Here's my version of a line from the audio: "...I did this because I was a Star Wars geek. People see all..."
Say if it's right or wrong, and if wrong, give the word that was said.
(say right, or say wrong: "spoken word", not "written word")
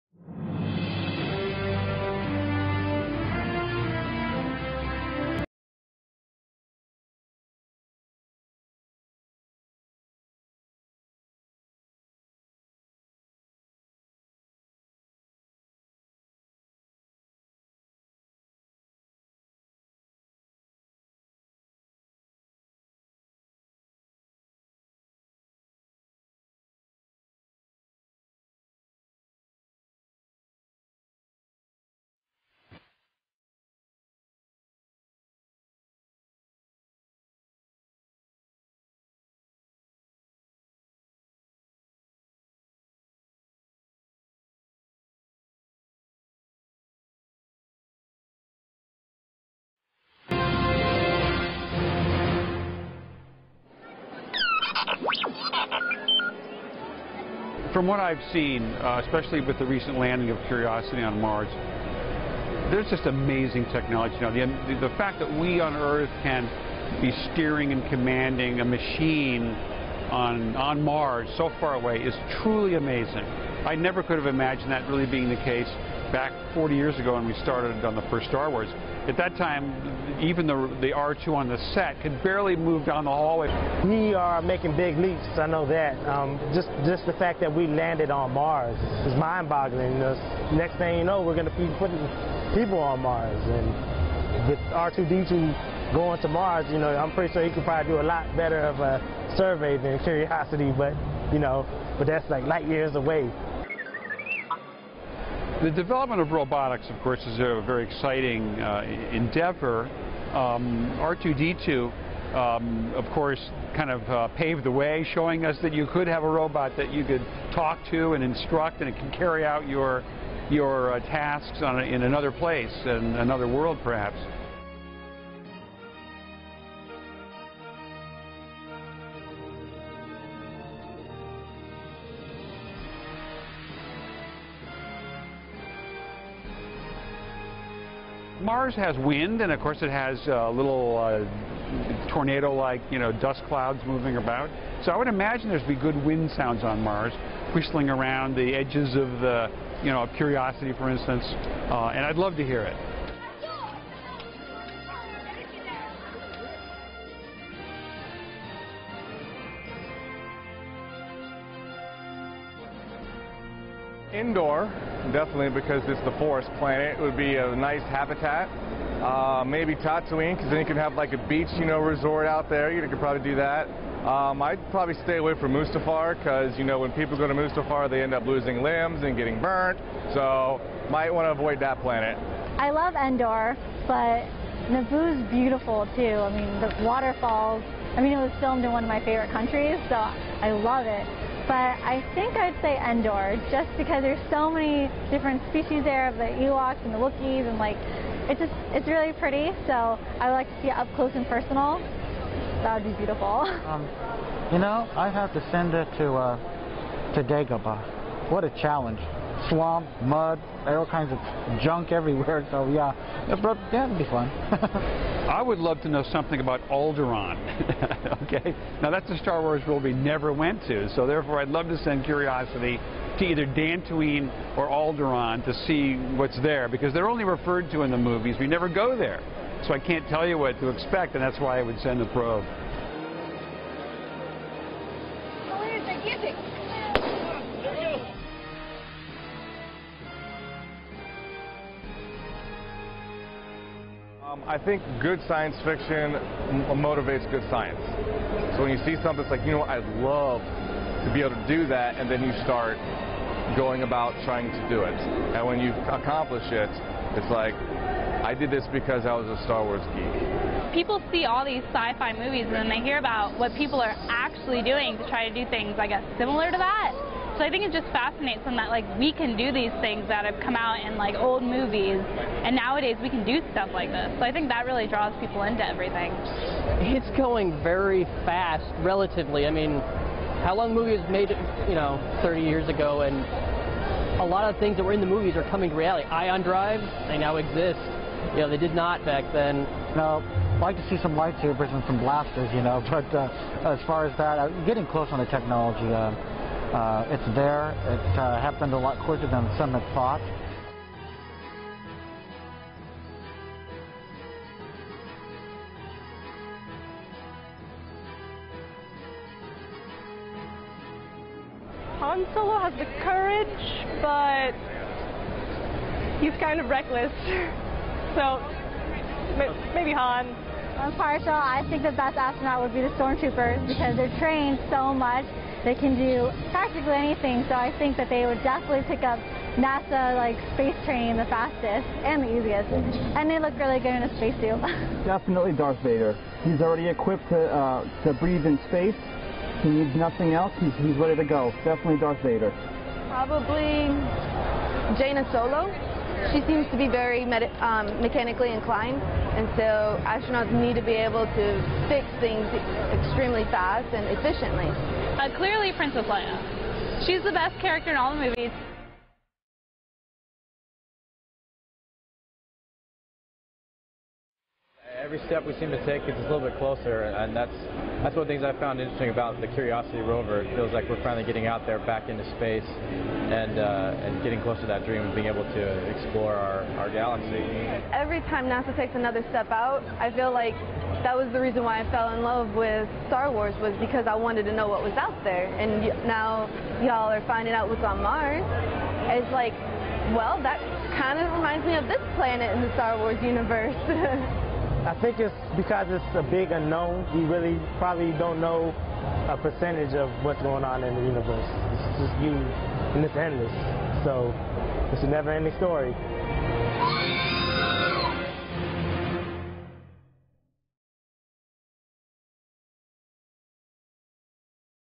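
right.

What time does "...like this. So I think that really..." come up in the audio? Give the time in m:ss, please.
4:33.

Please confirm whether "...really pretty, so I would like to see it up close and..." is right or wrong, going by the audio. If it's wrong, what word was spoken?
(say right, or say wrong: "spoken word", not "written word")
right.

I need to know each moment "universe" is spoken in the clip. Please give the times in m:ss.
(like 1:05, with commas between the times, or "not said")
6:33, 6:41.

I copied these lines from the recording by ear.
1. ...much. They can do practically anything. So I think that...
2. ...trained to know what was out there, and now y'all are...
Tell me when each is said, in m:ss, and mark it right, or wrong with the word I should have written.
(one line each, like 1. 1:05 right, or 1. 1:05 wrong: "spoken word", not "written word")
1. 5:24 right
2. 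6:24 wrong: "wanted", not "trained".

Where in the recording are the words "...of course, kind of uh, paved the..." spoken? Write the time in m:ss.
1:52.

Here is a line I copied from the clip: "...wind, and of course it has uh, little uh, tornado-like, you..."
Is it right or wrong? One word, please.
right.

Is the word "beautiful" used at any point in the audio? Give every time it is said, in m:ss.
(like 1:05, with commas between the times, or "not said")
3:05, 3:22.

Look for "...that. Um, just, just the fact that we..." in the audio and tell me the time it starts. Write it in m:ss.
1:25.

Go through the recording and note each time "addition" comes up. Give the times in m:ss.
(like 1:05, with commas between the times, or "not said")
not said.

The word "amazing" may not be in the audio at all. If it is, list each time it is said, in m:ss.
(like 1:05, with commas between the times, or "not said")
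1:03, 1:12.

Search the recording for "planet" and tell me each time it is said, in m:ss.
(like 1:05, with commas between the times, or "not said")
2:46, 3:01, 6:32.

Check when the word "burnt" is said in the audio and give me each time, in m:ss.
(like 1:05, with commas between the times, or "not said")
2:59.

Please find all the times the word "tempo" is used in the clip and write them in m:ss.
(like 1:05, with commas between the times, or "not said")
not said.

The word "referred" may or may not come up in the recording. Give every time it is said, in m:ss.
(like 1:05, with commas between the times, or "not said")
3:47.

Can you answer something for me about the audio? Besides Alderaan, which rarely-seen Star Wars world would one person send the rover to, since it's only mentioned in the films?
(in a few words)
Dantooine.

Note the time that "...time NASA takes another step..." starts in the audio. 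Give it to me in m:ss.
6:18.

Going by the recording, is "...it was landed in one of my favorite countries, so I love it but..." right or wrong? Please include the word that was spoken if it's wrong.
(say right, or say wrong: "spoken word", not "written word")
wrong: "filmed", not "landed".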